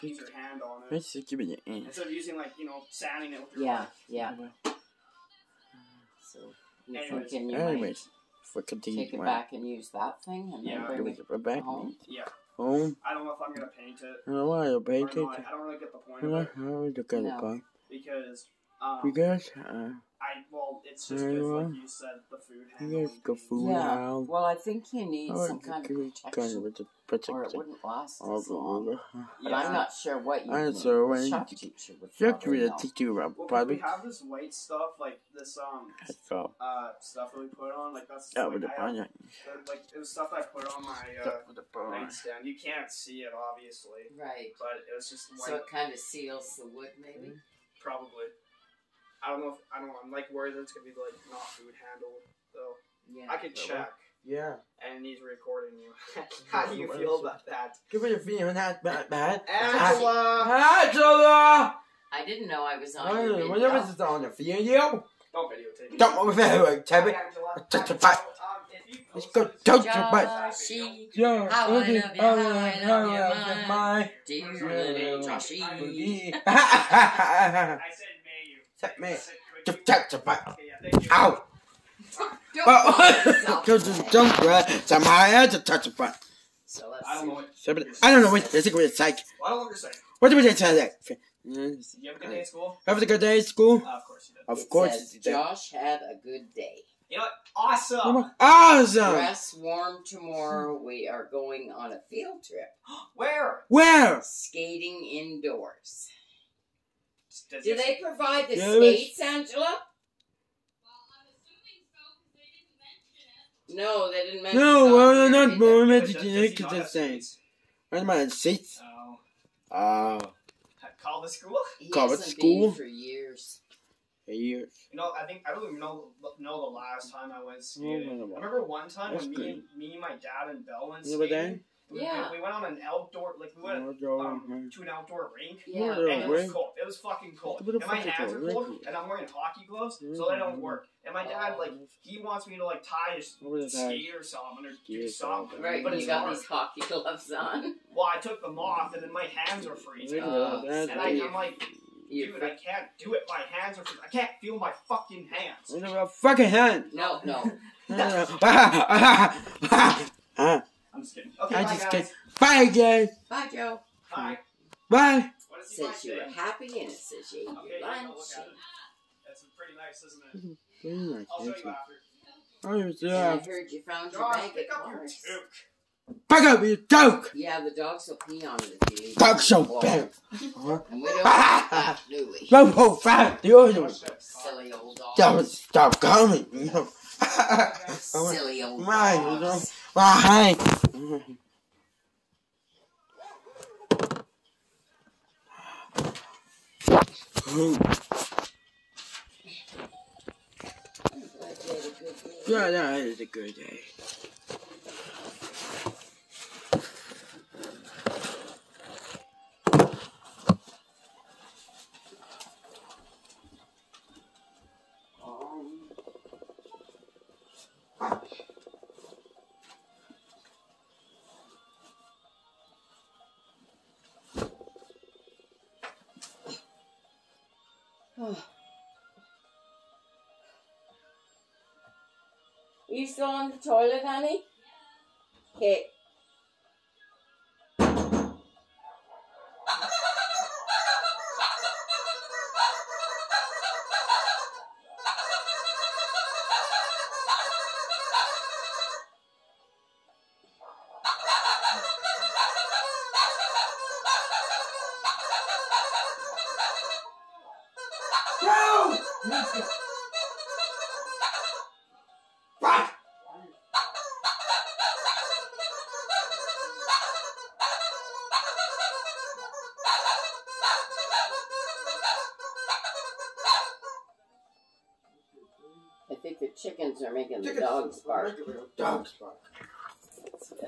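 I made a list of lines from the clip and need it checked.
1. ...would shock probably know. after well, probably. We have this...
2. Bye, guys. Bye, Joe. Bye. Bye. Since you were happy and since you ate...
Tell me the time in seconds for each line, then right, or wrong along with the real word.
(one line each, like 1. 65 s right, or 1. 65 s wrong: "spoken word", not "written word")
1. 32 s wrong: "teacher", not "after"
2. 162 s right.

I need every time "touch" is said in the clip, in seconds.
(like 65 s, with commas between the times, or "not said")
69 s, 85 s.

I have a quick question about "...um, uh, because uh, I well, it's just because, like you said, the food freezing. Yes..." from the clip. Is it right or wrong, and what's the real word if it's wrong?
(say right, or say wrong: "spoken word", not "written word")
wrong: "handling", not "freezing".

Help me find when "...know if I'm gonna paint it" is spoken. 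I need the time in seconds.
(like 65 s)
13 s.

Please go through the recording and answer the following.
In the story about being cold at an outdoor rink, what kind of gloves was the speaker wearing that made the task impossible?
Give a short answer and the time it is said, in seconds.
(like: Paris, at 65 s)
Hockey gloves, at 139 s.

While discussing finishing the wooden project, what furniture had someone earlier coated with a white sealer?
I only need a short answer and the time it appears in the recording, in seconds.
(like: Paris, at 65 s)
Nightstand, at 41 s.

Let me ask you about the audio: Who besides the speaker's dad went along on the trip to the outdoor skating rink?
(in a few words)
Bell.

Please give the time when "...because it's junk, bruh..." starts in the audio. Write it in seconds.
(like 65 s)
83 s.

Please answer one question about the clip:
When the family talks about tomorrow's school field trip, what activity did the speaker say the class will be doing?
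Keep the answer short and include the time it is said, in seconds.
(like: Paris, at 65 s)
Skating indoors, at 104 s.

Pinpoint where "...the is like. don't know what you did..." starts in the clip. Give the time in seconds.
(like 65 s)
88 s.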